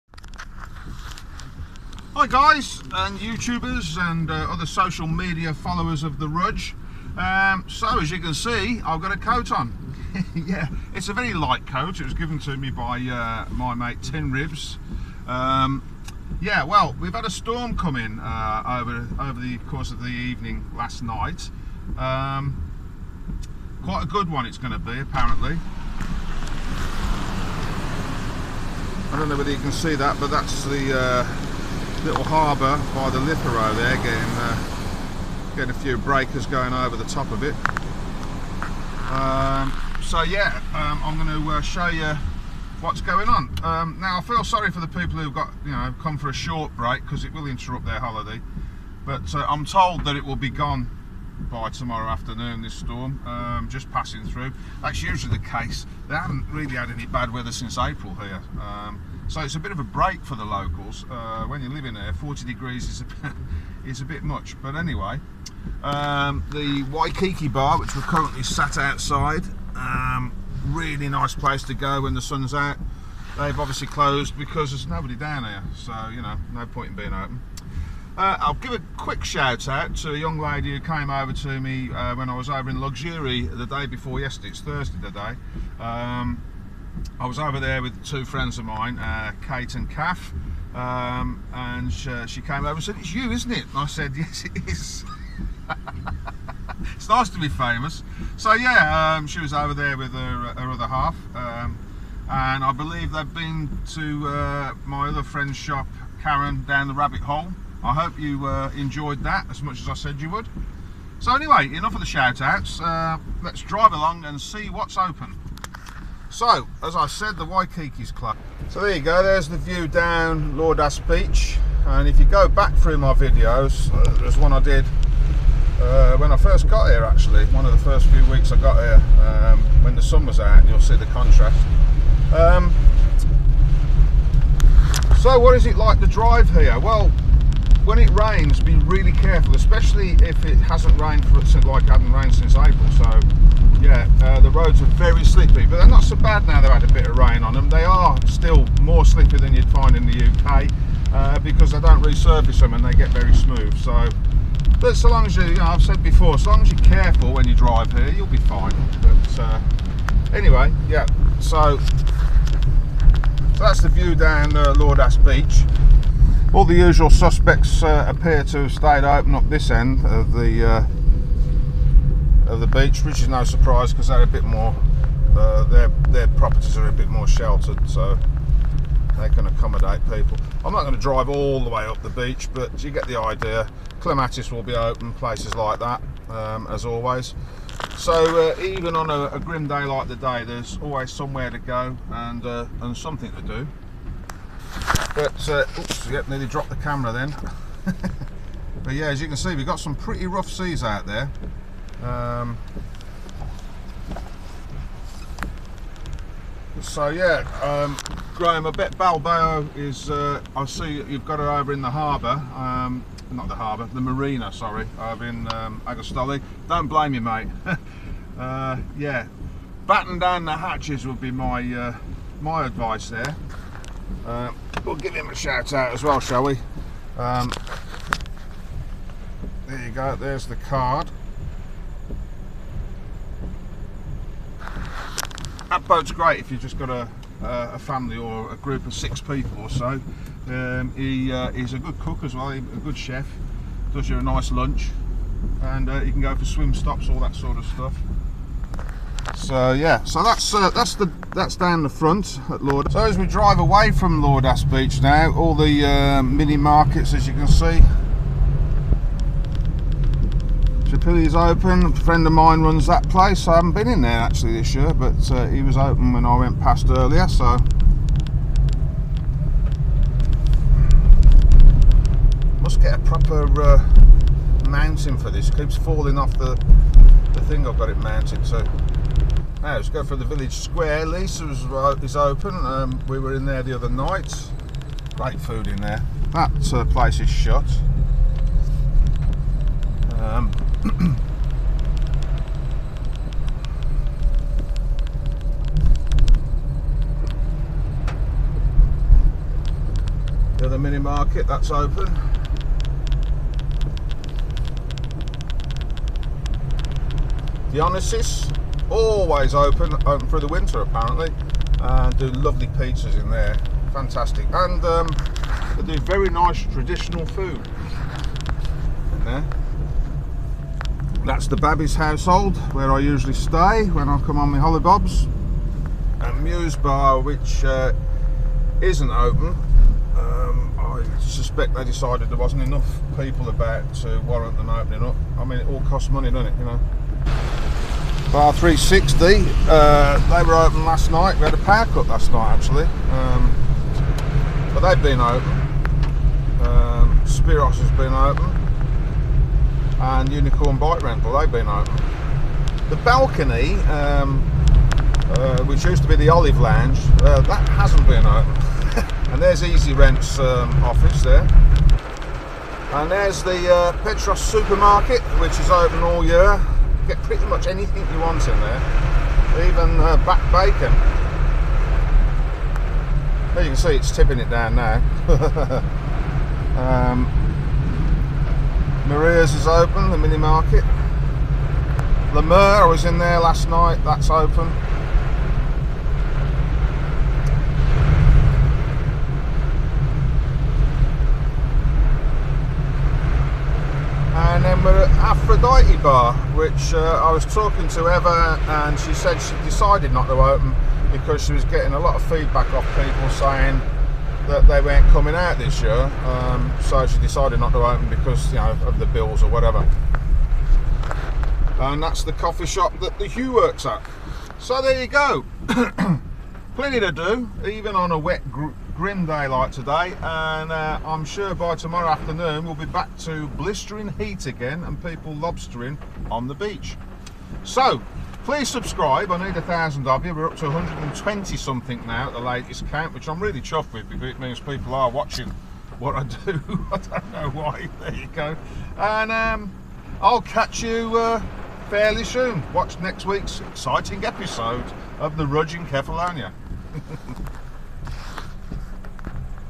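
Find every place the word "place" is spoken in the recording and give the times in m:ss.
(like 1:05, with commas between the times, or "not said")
1:11, 3:05, 4:23, 4:46.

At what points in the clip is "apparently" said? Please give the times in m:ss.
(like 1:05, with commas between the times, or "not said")
0:24, 5:10.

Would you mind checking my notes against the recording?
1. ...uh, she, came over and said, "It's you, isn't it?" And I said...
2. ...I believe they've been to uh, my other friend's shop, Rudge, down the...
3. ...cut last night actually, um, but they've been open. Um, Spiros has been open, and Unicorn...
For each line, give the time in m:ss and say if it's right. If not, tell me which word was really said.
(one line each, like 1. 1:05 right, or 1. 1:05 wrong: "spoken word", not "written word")
1. 1:32 right
2. 1:42 wrong: "Karen", not "Rudge"
3. 5:41 right.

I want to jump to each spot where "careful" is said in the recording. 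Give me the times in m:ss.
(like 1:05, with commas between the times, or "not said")
2:19, 2:36.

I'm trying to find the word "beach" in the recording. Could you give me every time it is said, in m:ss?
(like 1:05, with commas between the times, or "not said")
2:01, 2:45, 2:52, 3:02, 4:14, 7:06.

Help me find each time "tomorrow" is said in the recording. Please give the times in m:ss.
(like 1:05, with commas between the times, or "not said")
0:51, 7:01.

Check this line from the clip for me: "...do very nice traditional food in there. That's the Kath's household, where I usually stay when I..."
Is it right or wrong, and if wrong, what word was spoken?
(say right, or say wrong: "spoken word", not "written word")
wrong: "Babby", not "Kath".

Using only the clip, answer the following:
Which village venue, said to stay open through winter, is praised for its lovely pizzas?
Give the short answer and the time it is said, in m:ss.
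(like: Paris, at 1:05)
The Dionysus, at 5:07.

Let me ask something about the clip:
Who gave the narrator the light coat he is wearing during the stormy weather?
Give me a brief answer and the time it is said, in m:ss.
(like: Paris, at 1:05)
Tin Ribs, at 0:14.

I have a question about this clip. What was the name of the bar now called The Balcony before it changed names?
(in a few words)
Olive Lounge.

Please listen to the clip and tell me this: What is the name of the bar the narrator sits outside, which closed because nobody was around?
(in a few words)
Waikiki Bar.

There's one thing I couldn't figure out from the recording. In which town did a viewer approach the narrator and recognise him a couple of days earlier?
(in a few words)
Lixouri.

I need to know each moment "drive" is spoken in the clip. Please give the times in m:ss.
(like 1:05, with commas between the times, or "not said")
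1:53, 2:16, 2:37, 3:00, 4:13.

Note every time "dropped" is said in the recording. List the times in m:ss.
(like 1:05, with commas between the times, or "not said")
3:16.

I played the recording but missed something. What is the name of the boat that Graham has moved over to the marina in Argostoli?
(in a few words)
Balboa.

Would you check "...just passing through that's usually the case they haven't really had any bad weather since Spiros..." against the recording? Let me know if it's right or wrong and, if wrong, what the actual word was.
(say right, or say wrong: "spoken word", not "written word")
wrong: "April", not "Spiros".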